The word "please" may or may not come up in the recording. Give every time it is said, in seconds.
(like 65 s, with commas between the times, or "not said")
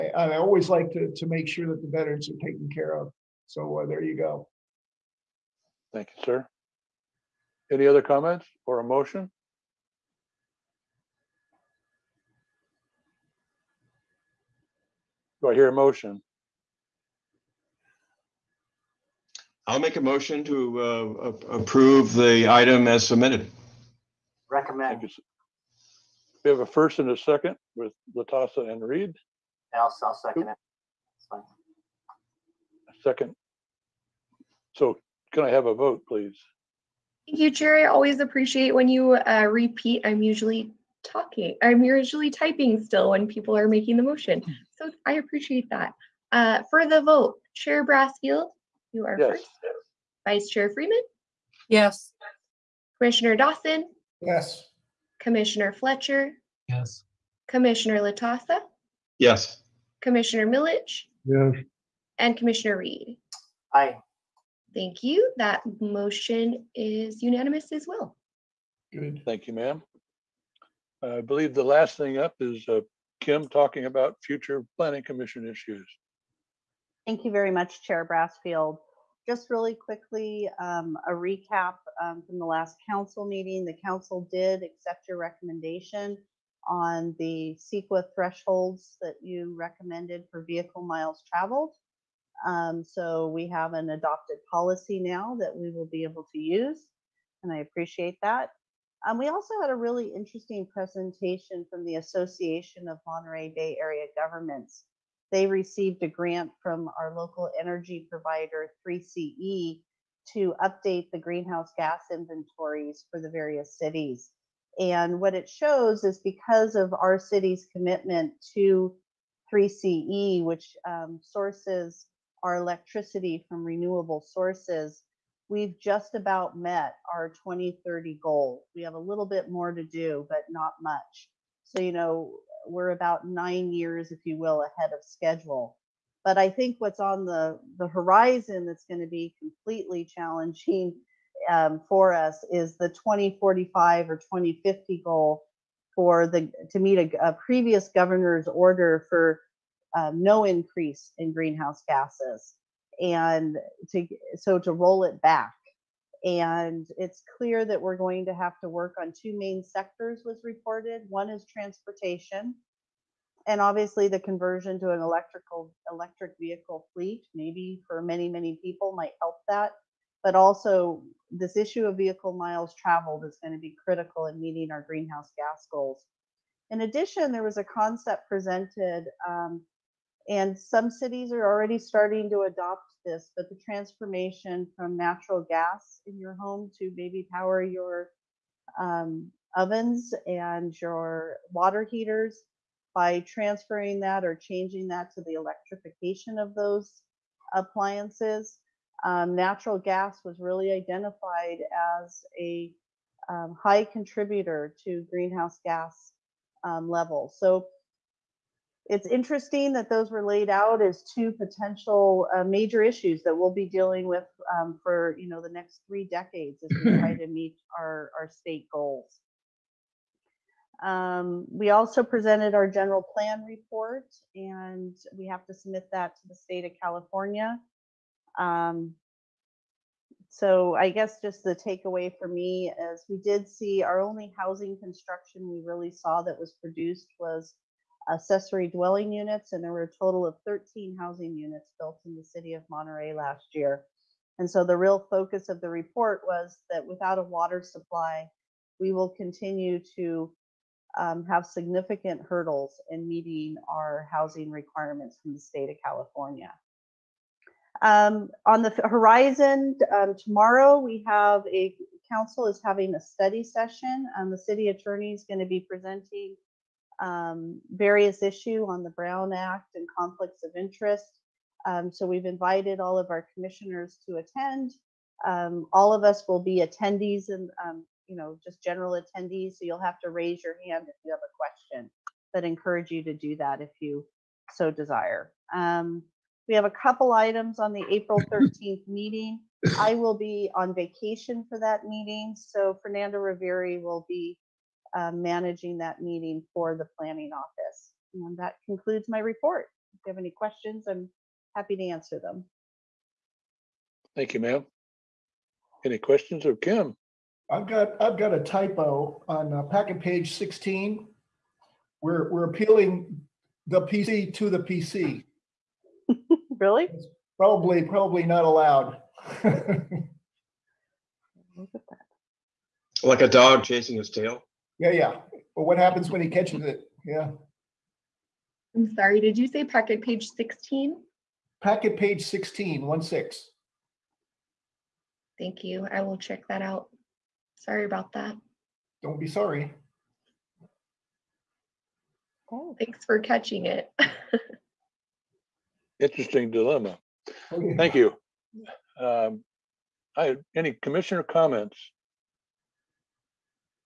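36 s.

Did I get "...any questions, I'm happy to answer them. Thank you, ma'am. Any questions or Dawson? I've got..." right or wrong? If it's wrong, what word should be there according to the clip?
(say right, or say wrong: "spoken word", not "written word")
wrong: "Kim", not "Dawson".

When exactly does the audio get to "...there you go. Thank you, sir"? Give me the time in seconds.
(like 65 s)
3 s.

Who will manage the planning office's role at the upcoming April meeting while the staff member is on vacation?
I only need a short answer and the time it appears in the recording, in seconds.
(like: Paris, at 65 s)
Fernando Riveri, at 292 s.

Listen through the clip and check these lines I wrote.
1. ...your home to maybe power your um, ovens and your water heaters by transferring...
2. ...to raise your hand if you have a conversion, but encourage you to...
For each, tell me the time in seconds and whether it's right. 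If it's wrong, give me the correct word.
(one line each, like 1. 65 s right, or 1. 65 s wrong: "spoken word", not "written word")
1. 186 s right
2. 280 s wrong: "question", not "conversion".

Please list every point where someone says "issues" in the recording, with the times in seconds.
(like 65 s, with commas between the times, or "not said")
75 s, 171 s, 212 s, 268 s.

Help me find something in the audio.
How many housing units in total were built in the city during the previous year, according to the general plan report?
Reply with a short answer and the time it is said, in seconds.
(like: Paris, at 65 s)
13, at 240 s.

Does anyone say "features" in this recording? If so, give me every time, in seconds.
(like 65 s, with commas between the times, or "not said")
not said.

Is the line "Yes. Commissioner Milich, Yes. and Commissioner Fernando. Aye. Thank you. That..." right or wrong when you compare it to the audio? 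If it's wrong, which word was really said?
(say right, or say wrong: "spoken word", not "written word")
wrong: "Reed", not "Fernando".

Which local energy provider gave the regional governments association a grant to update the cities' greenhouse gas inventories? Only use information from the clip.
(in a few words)
3CE.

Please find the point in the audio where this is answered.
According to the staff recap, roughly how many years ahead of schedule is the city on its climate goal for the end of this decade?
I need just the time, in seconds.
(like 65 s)
133 s.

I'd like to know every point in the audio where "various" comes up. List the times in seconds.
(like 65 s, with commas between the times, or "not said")
113 s, 267 s.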